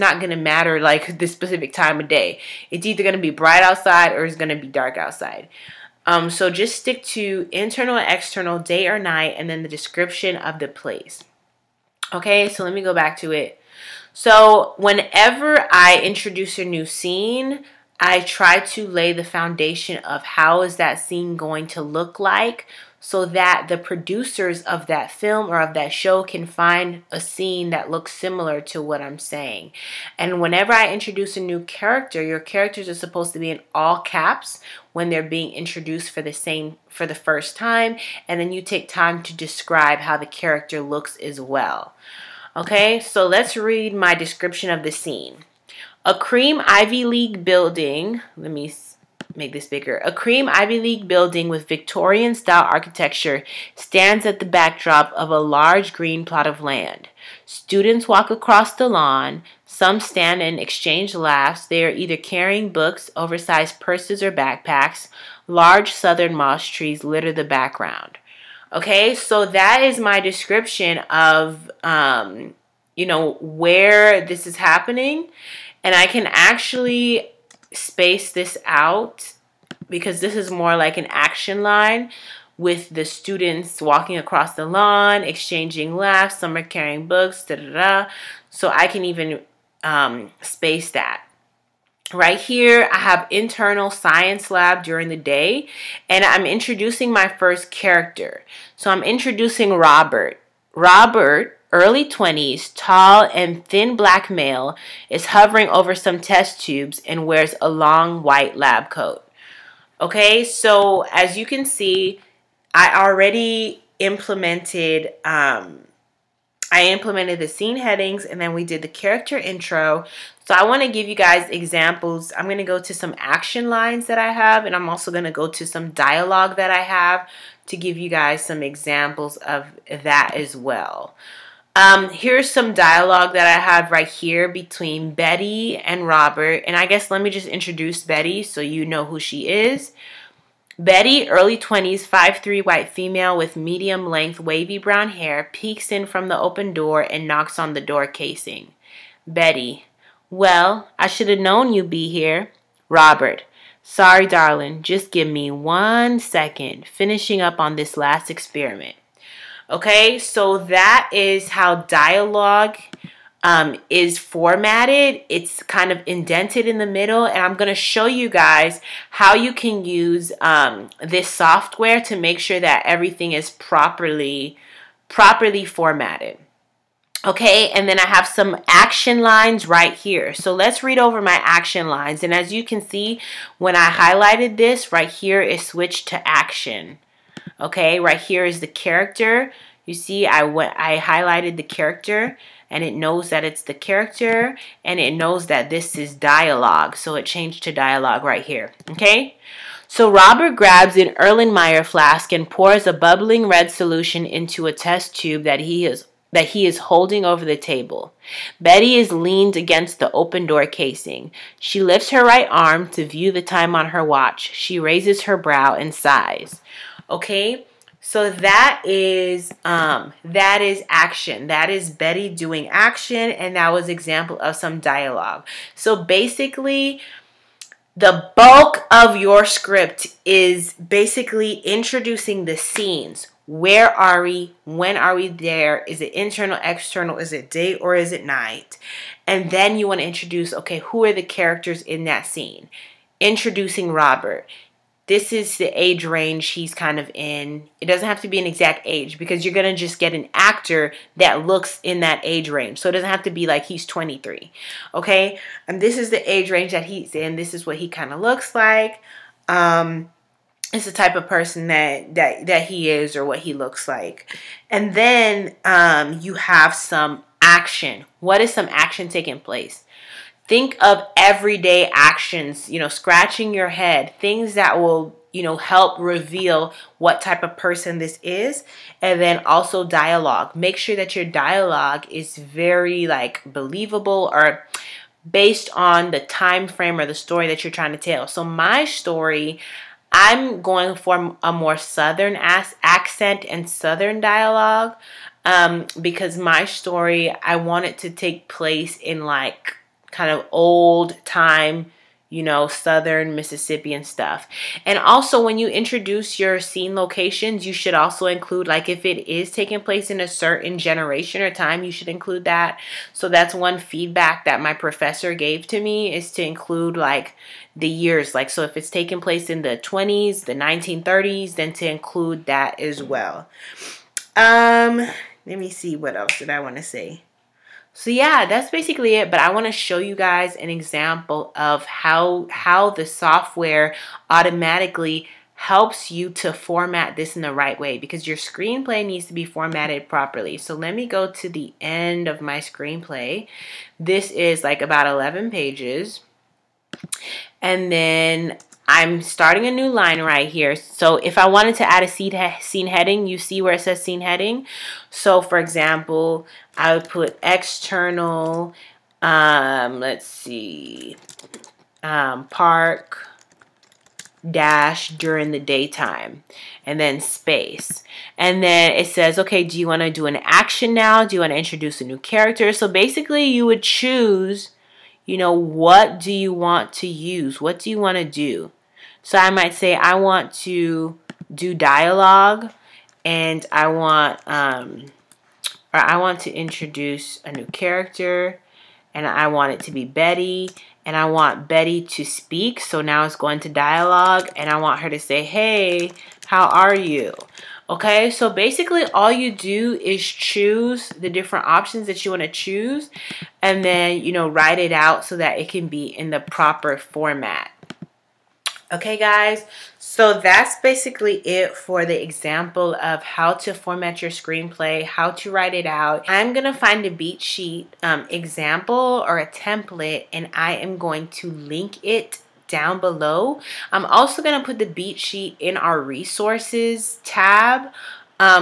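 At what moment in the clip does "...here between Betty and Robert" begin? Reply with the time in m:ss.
2:14.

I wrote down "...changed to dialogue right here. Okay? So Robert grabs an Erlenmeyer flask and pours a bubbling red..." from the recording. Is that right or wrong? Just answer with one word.
right.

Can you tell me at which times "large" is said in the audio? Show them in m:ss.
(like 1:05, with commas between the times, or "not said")
0:55, 1:05.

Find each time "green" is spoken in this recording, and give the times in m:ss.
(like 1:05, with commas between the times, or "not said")
0:55.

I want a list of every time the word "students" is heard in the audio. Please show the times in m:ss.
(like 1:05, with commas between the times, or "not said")
0:57, 1:23.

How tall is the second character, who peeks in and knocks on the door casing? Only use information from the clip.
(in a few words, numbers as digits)
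5'3.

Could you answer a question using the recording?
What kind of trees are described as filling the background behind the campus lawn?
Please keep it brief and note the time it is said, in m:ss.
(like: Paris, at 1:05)
Southern moss trees, at 1:05.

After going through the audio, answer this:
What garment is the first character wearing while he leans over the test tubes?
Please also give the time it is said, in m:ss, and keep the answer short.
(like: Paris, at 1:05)
Long white lab coat, at 1:47.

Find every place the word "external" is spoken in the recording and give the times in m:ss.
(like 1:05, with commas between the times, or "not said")
0:07, 3:56, 5:57.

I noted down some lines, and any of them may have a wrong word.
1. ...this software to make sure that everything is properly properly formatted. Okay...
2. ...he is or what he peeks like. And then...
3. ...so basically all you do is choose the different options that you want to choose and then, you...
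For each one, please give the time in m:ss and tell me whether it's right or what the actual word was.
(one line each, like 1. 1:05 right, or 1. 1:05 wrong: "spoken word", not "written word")
1. 2:51 right
2. 4:22 wrong: "looks", not "peeks"
3. 6:38 right.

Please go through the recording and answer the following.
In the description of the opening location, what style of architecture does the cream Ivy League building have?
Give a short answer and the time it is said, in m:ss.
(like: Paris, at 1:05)
Victorian, at 0:51.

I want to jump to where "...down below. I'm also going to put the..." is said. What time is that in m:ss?
7:02.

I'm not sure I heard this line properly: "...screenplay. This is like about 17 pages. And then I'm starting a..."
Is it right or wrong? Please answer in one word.
wrong.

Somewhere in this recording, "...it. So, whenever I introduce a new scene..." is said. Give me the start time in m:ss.
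0:13.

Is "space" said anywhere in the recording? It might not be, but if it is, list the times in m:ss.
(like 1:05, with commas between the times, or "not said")
1:17, 1:30, 6:07.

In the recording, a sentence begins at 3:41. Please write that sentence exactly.
That is Betty doing action, and that was example of some dialogue.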